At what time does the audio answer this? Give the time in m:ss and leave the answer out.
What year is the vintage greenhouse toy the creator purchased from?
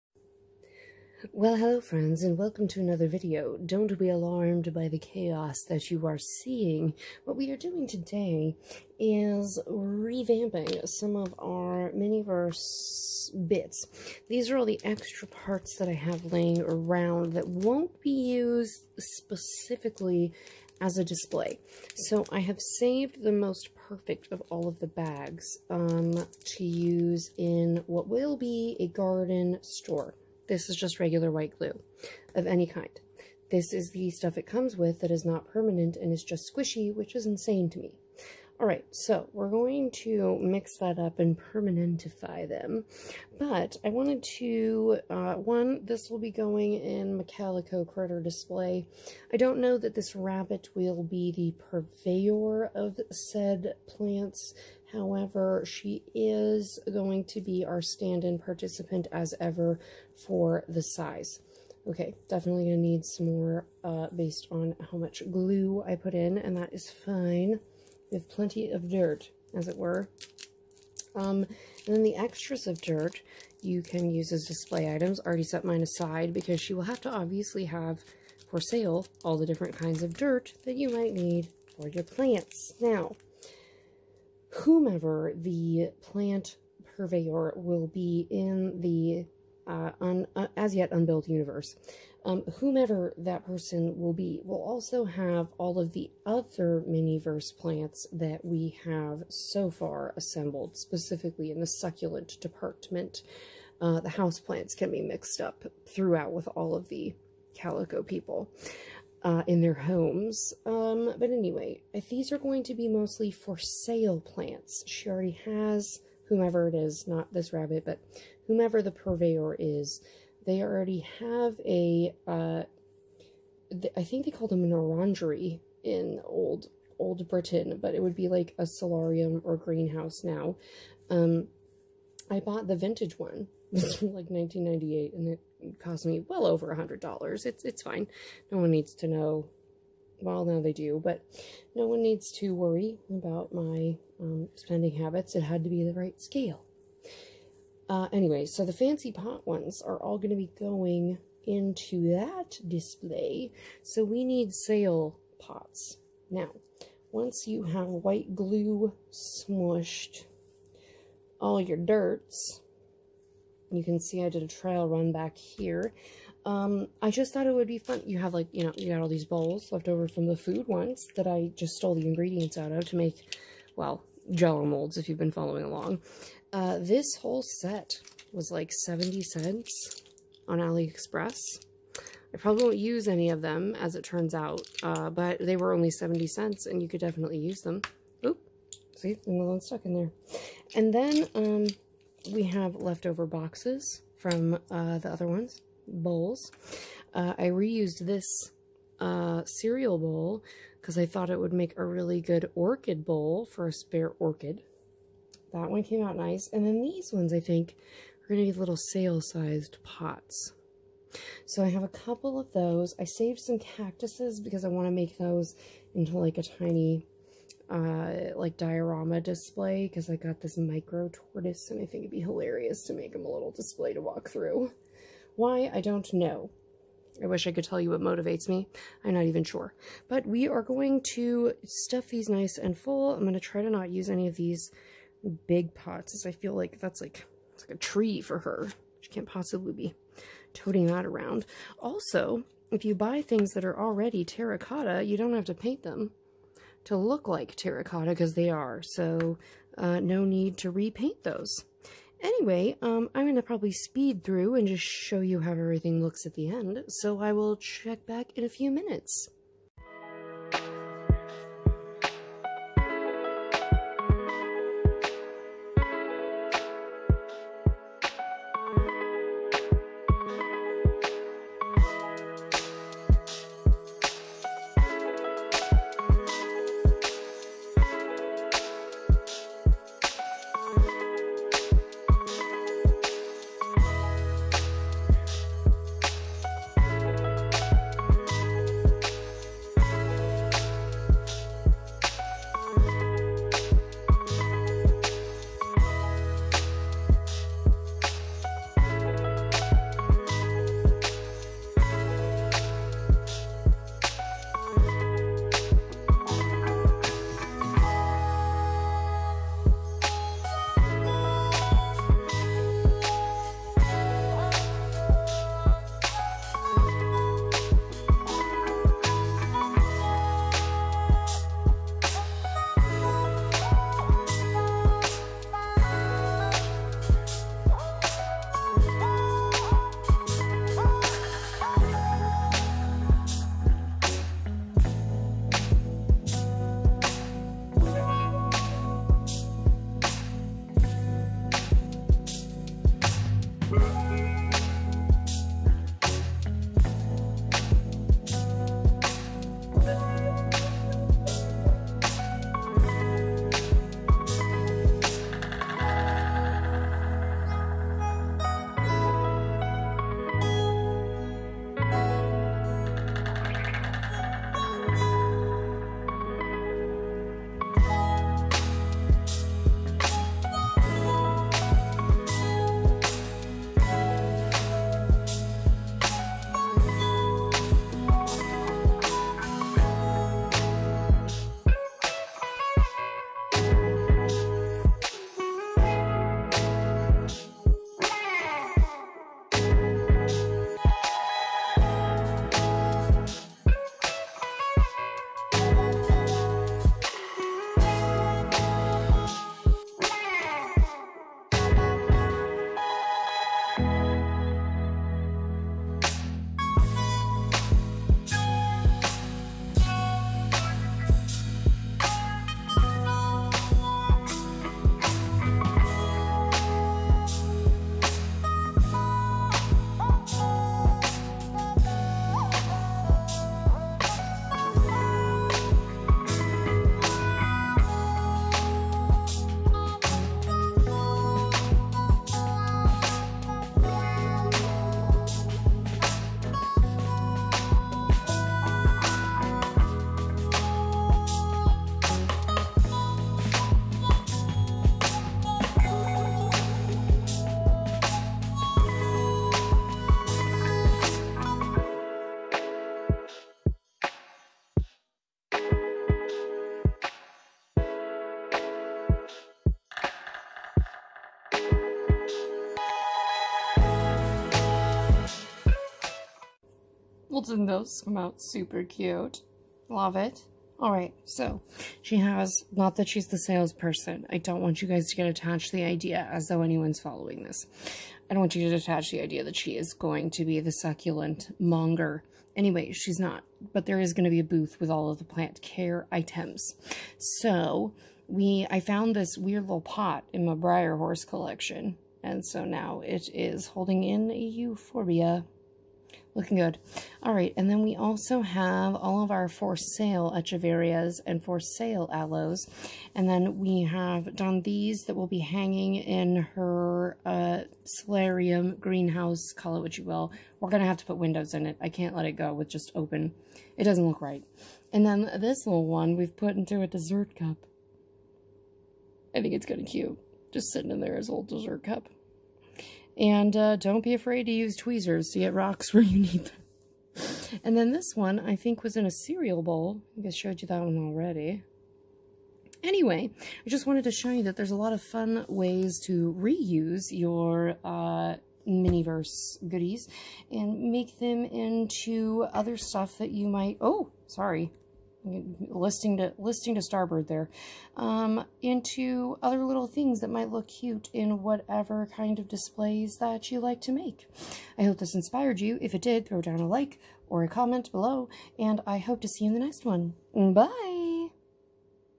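2:14.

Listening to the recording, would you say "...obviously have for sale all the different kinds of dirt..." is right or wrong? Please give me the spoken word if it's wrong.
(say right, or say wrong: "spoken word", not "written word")
right.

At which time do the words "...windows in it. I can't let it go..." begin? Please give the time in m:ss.
8:31.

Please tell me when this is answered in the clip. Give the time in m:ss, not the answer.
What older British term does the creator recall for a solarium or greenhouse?
2:04.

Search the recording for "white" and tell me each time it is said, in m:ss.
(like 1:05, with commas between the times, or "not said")
0:31, 2:37.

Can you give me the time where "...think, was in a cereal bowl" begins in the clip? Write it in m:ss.
8:48.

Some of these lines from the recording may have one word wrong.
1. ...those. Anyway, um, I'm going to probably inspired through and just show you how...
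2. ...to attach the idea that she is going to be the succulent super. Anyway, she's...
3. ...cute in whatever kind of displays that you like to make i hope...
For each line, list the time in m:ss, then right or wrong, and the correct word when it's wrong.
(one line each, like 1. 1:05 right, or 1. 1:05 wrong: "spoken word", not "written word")
1. 4:11 wrong: "speed", not "inspired"
2. 7:58 wrong: "monger", not "super"
3. 9:10 right.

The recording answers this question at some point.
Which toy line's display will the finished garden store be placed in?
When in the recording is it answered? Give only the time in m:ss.
0:47.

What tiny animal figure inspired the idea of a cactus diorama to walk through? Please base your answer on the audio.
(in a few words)
micro tortoise.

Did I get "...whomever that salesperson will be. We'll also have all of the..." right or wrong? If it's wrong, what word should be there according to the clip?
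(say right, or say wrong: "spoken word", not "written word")
wrong: "person", not "salesperson".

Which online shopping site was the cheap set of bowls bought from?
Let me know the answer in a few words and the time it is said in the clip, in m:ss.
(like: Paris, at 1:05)
AliExpress, at 3:00.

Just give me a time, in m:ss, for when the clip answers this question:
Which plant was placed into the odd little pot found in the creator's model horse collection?
8:14.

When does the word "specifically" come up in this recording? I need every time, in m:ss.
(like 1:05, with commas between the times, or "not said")
0:18, 1:40.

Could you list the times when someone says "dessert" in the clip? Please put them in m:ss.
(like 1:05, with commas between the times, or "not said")
8:36, 8:41.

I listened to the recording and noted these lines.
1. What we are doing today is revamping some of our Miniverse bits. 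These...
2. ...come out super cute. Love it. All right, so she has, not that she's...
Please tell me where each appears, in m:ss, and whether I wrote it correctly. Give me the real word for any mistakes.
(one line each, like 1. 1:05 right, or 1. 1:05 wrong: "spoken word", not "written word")
1. 0:07 right
2. 7:48 right.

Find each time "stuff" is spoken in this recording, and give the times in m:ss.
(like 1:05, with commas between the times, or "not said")
0:34, 3:51, 9:02.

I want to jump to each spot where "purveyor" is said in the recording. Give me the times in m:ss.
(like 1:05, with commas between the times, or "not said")
0:51, 1:26, 1:58.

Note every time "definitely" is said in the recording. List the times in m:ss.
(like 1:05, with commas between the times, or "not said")
1:02, 3:07.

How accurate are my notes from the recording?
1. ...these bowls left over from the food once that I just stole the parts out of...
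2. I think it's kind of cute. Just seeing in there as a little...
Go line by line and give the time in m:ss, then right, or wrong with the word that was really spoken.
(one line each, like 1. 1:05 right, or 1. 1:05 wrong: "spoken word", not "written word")
1. 2:49 wrong: "ingredients", not "parts"
2. 8:39 wrong: "sitting", not "seeing".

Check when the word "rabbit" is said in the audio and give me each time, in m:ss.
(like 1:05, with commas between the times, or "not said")
0:50, 1:57.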